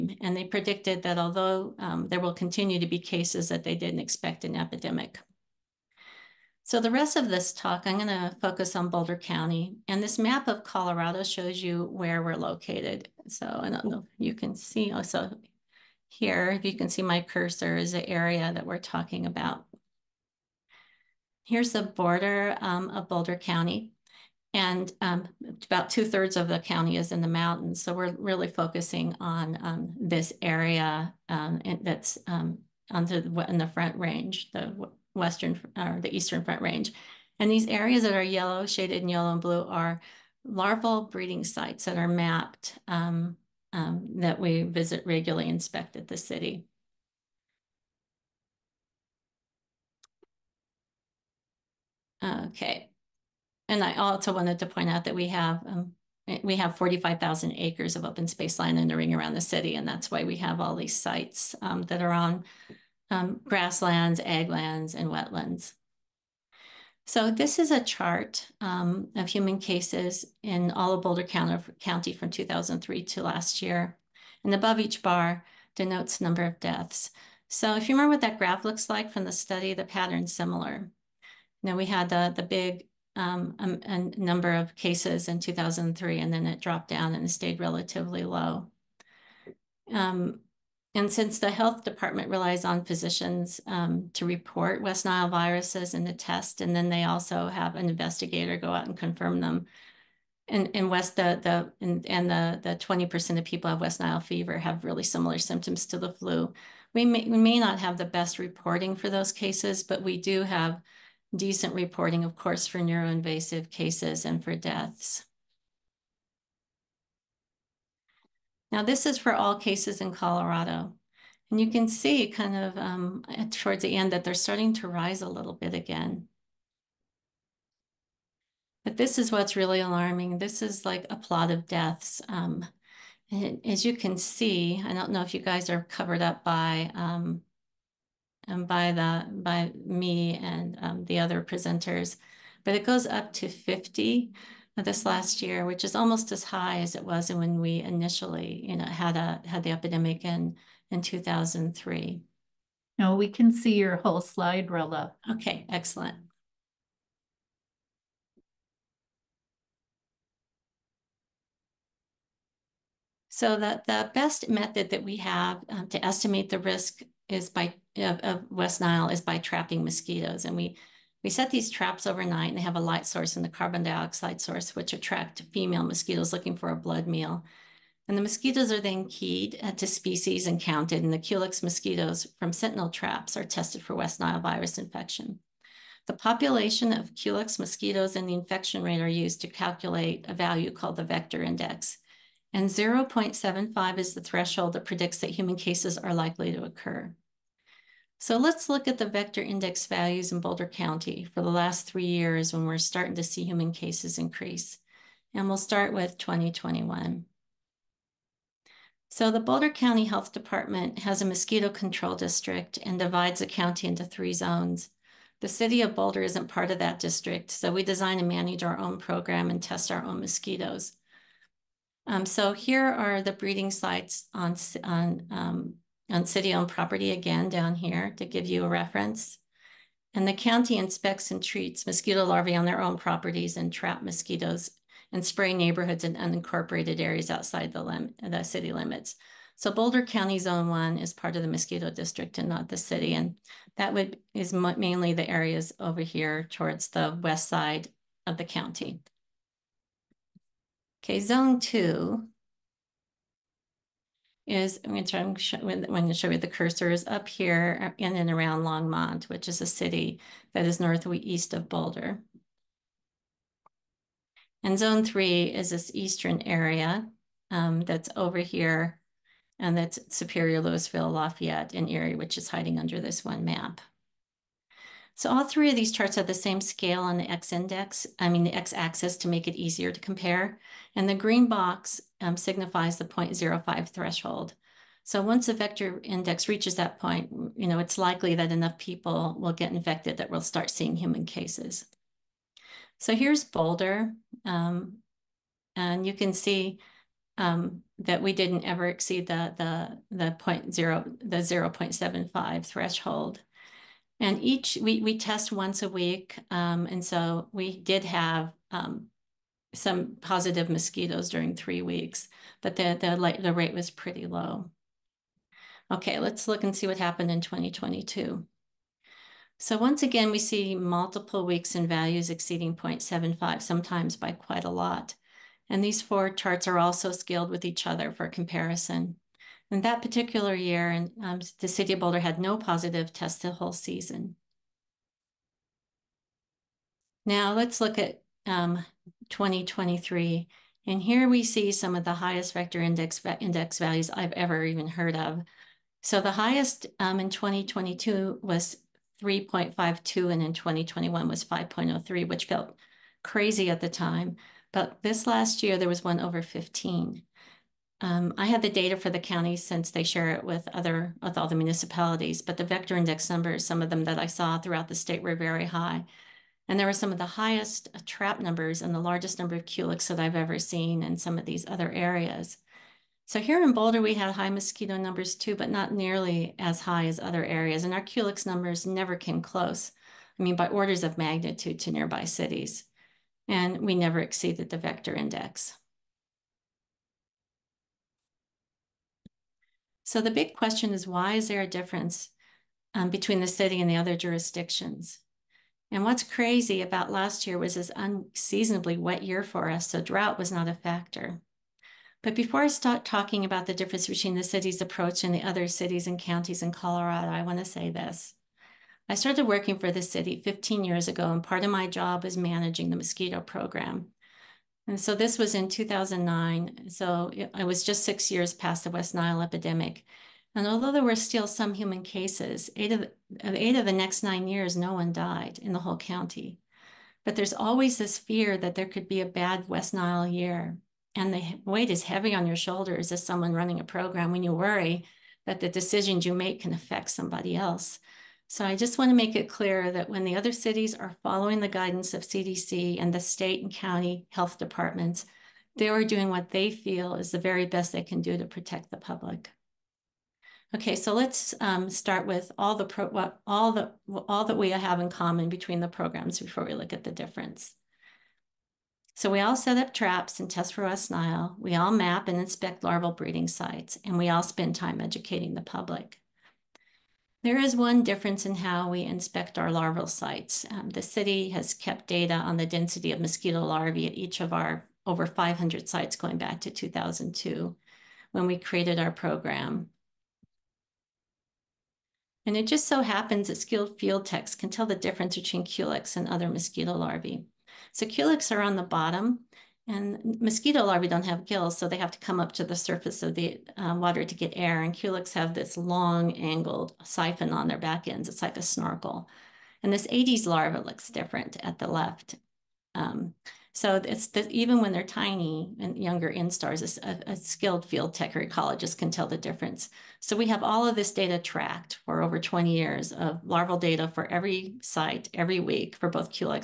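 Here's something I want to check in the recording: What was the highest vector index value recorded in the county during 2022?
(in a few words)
3.52.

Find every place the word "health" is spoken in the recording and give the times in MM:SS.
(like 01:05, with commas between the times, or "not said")
01:31, 03:30, 07:24.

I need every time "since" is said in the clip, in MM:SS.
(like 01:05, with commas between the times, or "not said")
01:31, 05:59.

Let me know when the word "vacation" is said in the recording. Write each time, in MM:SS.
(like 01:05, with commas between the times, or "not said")
not said.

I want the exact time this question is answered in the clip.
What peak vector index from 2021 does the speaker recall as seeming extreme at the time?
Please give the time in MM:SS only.
05:51.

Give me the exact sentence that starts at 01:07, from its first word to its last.
So this is a chart um, of human cases in all of Boulder County from 2003 to last year.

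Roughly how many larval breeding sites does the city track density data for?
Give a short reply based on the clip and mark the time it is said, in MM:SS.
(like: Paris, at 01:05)
over 500, at 07:55.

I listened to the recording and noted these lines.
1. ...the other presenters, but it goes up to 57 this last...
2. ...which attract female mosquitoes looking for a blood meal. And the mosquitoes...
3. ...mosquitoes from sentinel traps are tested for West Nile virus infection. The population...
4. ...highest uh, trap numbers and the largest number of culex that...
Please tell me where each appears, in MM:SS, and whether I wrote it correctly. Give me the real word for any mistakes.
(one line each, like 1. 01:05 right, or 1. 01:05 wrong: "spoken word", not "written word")
1. 02:21 wrong: "50", not "57"
2. 02:54 right
3. 03:01 right
4. 06:07 right.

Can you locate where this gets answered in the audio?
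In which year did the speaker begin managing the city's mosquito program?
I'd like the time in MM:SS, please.
06:55.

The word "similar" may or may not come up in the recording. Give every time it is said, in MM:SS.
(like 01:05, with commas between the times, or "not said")
01:20, 01:45.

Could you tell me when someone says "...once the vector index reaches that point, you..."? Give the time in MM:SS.
04:45.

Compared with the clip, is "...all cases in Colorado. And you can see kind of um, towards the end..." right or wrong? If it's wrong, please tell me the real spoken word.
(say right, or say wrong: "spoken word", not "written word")
right.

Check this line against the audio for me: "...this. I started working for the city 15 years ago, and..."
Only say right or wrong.
right.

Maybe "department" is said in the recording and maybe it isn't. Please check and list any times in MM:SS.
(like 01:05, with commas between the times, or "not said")
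01:31, 03:30, 07:24.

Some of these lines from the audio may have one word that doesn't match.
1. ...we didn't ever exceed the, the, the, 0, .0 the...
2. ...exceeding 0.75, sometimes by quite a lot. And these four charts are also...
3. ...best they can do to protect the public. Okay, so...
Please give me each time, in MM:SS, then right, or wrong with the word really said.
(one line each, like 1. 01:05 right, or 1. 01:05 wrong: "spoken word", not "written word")
1. 04:58 right
2. 05:22 right
3. 07:27 right.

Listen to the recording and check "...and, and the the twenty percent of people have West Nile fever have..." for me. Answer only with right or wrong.
right.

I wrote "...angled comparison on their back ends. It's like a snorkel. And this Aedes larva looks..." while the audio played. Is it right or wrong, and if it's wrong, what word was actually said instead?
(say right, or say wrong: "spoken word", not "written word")
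wrong: "siphon", not "comparison".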